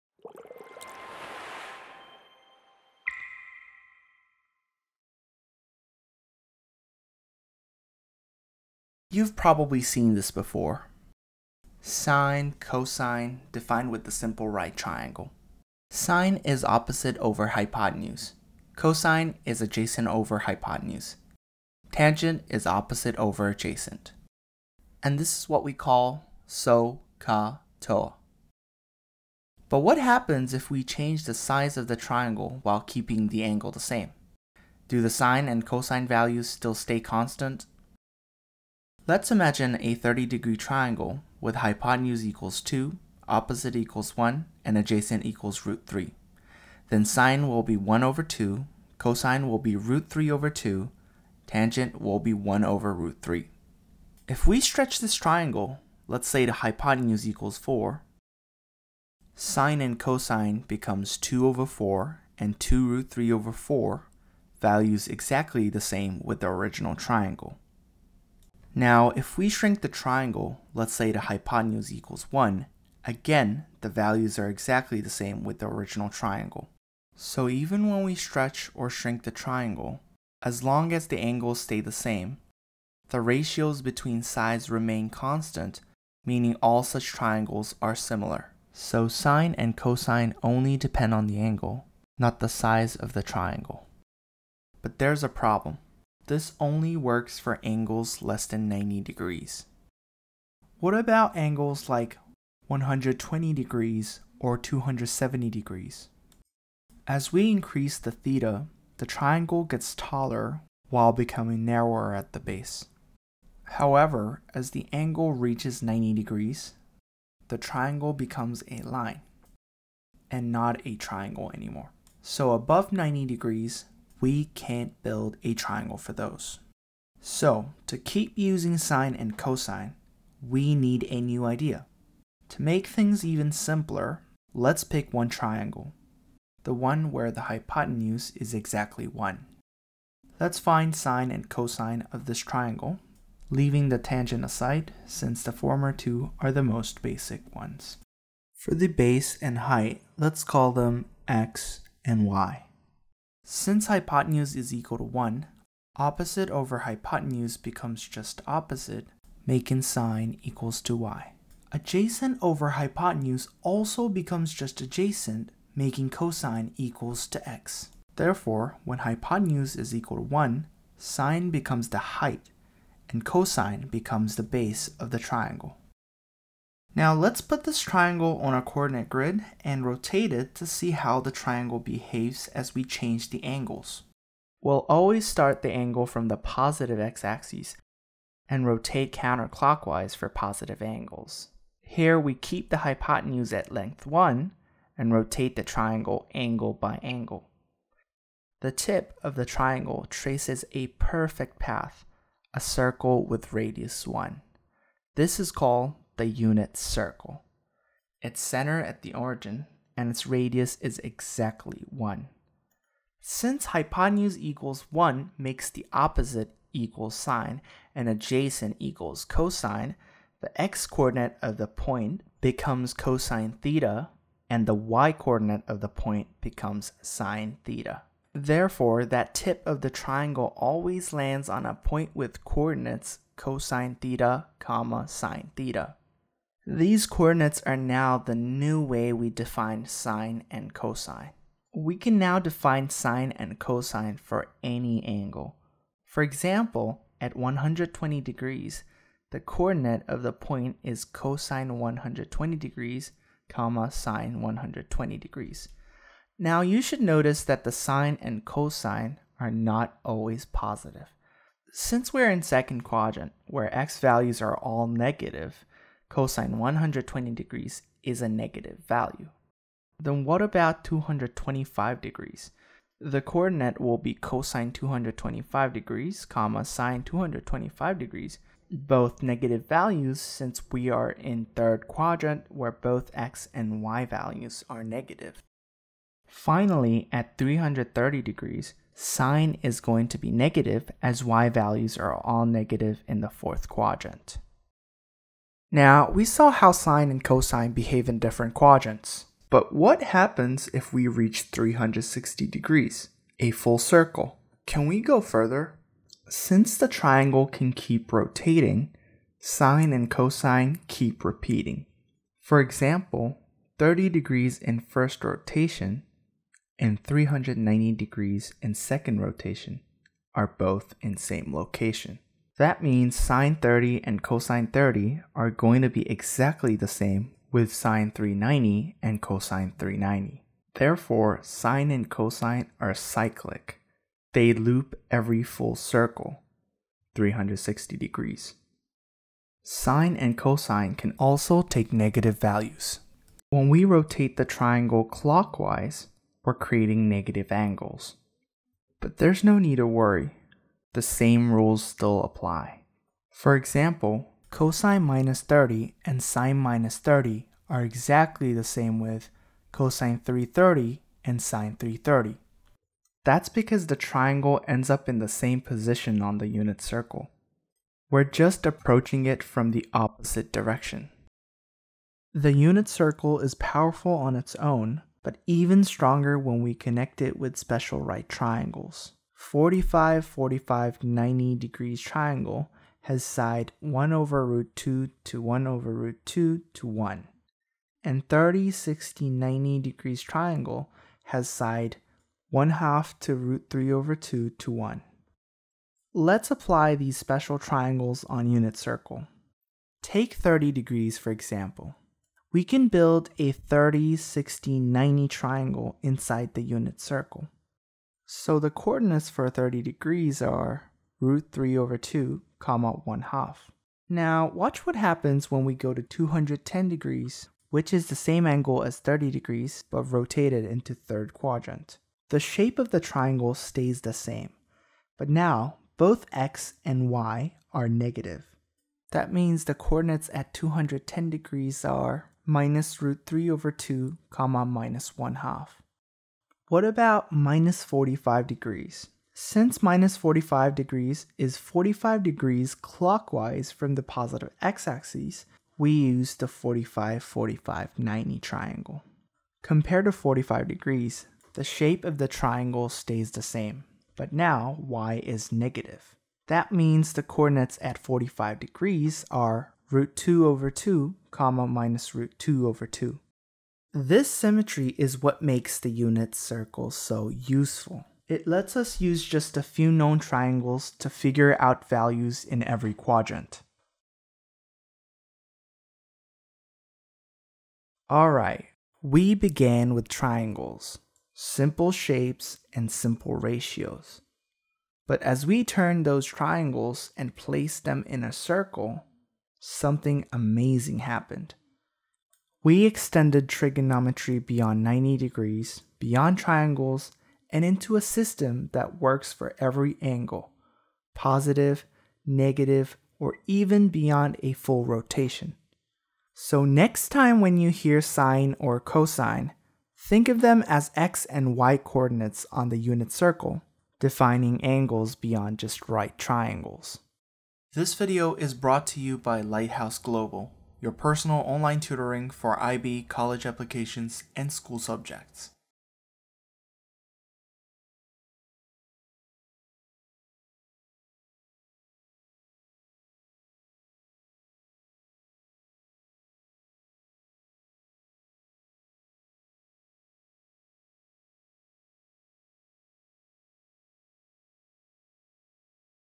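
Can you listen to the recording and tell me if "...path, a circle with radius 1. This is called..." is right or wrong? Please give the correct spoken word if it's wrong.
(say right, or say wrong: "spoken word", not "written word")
right.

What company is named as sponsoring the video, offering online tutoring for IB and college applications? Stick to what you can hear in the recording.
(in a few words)
Lighthouse Global.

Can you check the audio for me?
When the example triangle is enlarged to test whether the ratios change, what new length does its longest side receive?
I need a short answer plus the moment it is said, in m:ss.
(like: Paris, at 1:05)
4, at 0:56.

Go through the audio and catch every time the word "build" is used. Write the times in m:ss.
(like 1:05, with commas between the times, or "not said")
2:05, 6:42.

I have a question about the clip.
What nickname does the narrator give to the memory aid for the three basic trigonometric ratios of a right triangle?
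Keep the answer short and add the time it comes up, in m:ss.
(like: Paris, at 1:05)
so ka toa, at 0:26.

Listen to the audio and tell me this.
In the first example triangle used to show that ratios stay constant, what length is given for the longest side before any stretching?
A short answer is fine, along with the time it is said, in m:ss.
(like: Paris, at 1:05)
2, at 0:41.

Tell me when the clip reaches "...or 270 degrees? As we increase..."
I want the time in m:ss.
1:44.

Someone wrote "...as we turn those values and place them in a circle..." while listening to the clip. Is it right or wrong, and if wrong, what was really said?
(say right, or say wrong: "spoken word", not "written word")
wrong: "triangles", not "values".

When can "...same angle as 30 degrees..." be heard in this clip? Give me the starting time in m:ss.
6:58.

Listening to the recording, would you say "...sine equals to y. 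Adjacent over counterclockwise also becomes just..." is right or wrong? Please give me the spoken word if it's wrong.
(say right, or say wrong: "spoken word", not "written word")
wrong: "hypotenuse", not "counterclockwise".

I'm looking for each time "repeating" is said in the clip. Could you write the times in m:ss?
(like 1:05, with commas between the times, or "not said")
5:11.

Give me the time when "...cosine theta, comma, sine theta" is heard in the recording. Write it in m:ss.
3:53.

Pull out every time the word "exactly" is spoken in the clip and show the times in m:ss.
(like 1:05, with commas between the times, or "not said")
1:05, 1:14, 2:18, 3:30, 5:26, 5:57.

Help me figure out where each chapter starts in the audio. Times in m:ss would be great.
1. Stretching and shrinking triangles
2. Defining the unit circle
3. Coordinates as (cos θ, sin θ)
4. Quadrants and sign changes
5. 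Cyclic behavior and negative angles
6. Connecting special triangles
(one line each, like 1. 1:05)
1. 0:29
2. 2:07
3. 3:33
4. 4:06
5. 4:59
6. 6:12.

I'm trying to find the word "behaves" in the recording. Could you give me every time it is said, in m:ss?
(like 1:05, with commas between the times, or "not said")
3:01, 4:57.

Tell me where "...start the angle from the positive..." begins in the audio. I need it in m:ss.
3:05.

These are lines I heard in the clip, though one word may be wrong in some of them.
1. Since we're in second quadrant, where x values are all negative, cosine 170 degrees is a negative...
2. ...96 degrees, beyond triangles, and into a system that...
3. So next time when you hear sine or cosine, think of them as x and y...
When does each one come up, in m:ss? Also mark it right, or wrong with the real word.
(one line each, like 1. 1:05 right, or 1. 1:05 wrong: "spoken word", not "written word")
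1. 4:21 wrong: "120", not "170"
2. 8:14 wrong: "90", not "96"
3. 8:26 right.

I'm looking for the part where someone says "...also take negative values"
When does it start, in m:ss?
5:41.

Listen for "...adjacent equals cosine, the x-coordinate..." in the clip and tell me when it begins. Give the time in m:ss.
3:38.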